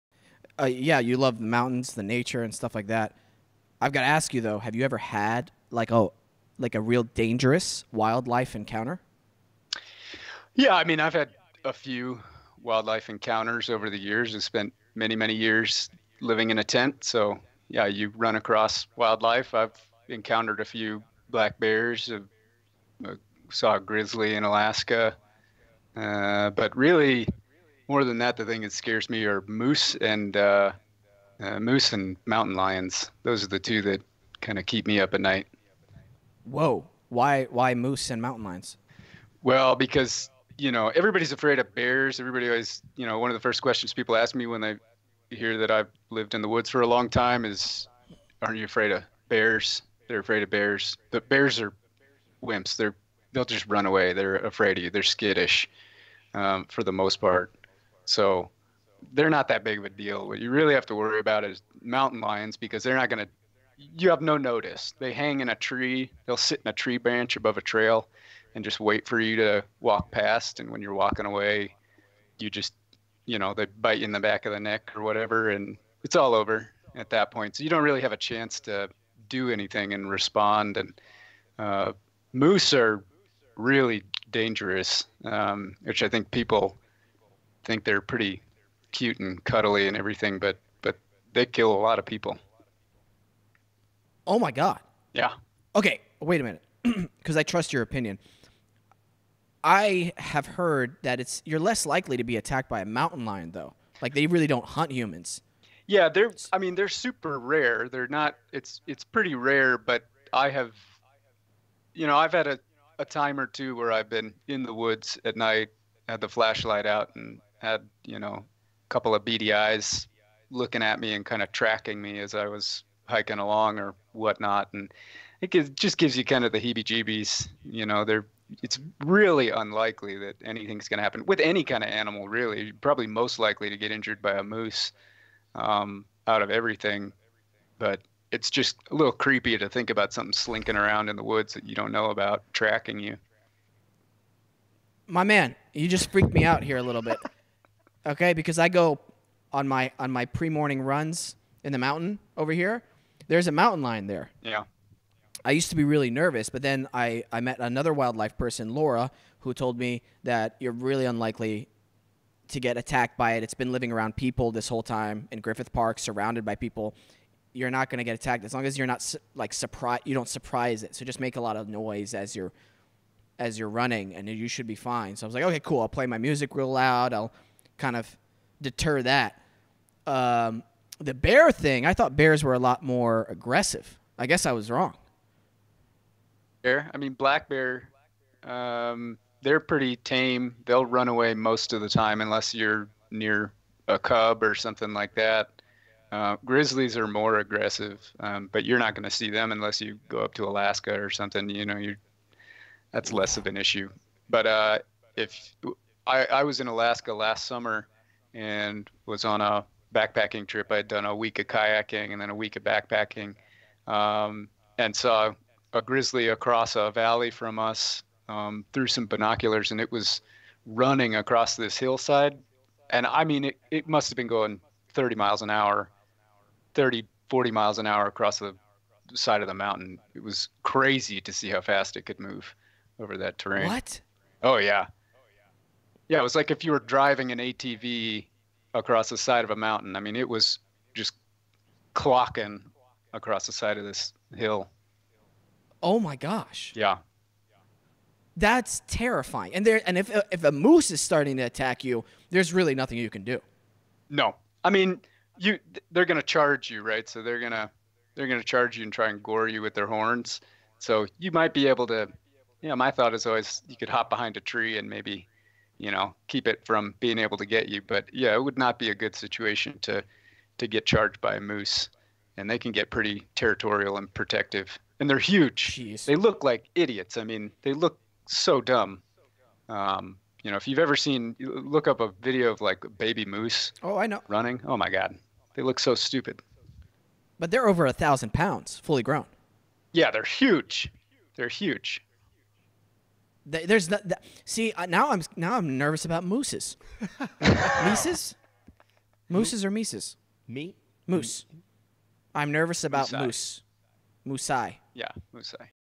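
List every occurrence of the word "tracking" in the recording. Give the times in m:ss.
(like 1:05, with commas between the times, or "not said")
2:01, 2:22.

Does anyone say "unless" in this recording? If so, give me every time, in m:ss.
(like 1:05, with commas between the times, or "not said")
3:12, 3:19.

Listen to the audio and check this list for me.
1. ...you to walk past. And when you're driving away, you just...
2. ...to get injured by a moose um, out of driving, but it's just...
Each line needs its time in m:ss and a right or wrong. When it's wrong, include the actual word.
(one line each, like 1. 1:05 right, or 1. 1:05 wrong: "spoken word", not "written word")
1. 1:09 wrong: "walking", not "driving"
2. 2:13 wrong: "everything", not "driving".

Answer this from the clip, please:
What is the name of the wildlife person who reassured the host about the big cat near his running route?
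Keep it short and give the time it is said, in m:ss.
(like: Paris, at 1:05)
Laura, at 2:38.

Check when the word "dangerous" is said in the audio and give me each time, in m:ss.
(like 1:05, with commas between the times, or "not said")
0:07, 1:24.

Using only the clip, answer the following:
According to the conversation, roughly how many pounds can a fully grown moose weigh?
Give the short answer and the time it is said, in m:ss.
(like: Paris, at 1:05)
Over 1,000 pounds, at 4:47.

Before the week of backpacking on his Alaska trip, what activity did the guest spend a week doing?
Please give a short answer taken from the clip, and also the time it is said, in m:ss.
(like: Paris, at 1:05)
Kayaking, at 3:31.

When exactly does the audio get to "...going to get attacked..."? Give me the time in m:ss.
2:47.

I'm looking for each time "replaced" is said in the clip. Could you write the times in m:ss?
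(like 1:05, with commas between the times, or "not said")
not said.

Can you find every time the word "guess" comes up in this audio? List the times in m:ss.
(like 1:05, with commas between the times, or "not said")
3:04.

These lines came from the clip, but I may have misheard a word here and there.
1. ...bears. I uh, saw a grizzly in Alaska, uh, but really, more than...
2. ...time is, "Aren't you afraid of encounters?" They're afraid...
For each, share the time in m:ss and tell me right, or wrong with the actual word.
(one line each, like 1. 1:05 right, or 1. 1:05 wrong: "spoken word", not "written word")
1. 0:21 right
2. 0:47 wrong: "bears", not "encounters".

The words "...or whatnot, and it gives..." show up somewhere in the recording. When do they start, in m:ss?
2:03.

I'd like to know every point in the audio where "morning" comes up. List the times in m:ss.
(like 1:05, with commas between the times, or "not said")
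2:30.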